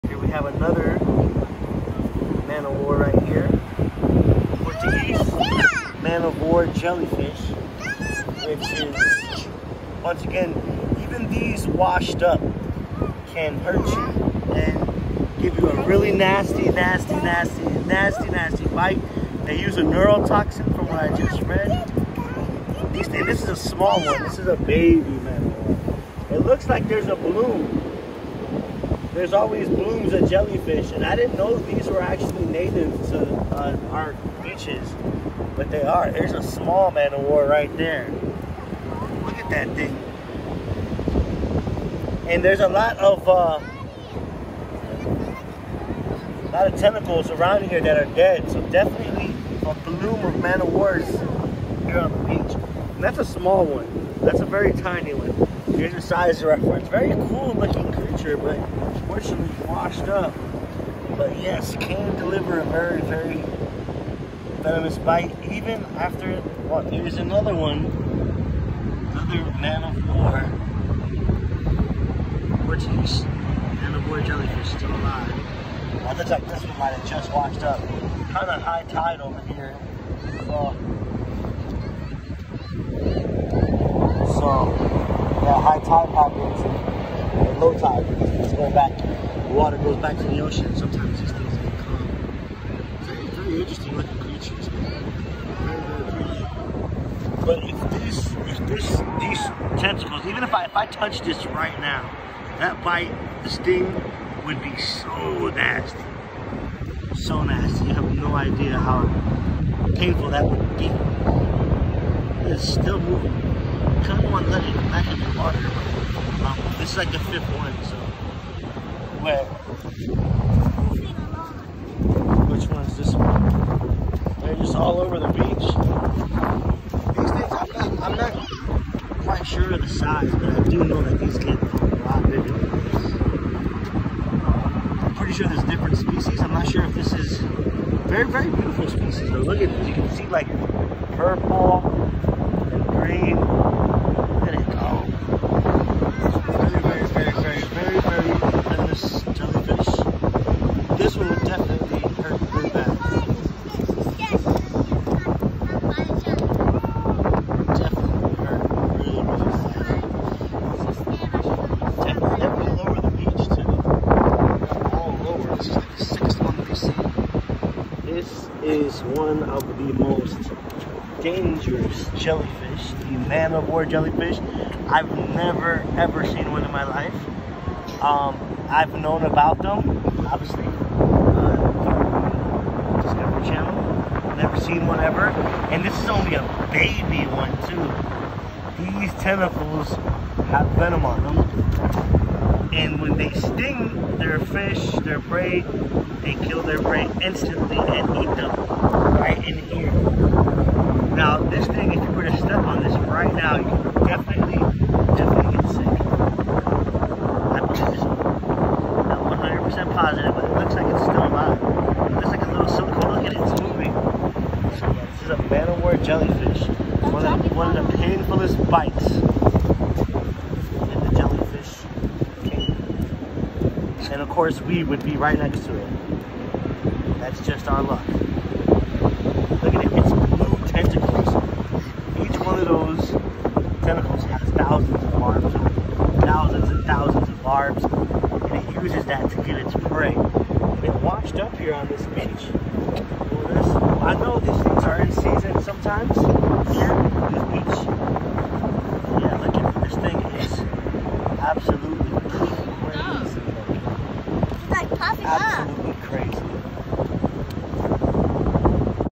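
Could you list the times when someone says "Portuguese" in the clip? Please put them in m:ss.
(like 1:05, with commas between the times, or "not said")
0:04, 1:12.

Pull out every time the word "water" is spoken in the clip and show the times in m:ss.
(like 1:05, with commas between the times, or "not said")
1:29, 1:55.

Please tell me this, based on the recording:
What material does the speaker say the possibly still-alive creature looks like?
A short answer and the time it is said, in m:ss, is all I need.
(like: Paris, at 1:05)
Silicone, at 3:32.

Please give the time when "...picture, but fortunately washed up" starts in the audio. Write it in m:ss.
0:58.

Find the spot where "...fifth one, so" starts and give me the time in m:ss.
1:57.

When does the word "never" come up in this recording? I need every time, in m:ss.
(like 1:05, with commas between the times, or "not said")
2:55, 3:04.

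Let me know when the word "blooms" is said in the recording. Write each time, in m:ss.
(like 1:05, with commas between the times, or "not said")
0:29, 0:49.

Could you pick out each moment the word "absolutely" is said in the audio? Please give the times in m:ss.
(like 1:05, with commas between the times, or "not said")
4:11, 4:15.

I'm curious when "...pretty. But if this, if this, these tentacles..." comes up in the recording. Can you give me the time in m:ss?
1:36.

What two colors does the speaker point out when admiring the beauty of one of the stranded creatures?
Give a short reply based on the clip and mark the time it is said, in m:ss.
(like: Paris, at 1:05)
Purple and green, at 2:21.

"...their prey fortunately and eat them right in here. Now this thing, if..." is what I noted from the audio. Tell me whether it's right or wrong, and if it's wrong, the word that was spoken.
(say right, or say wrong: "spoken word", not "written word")
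wrong: "instantly", not "fortunately".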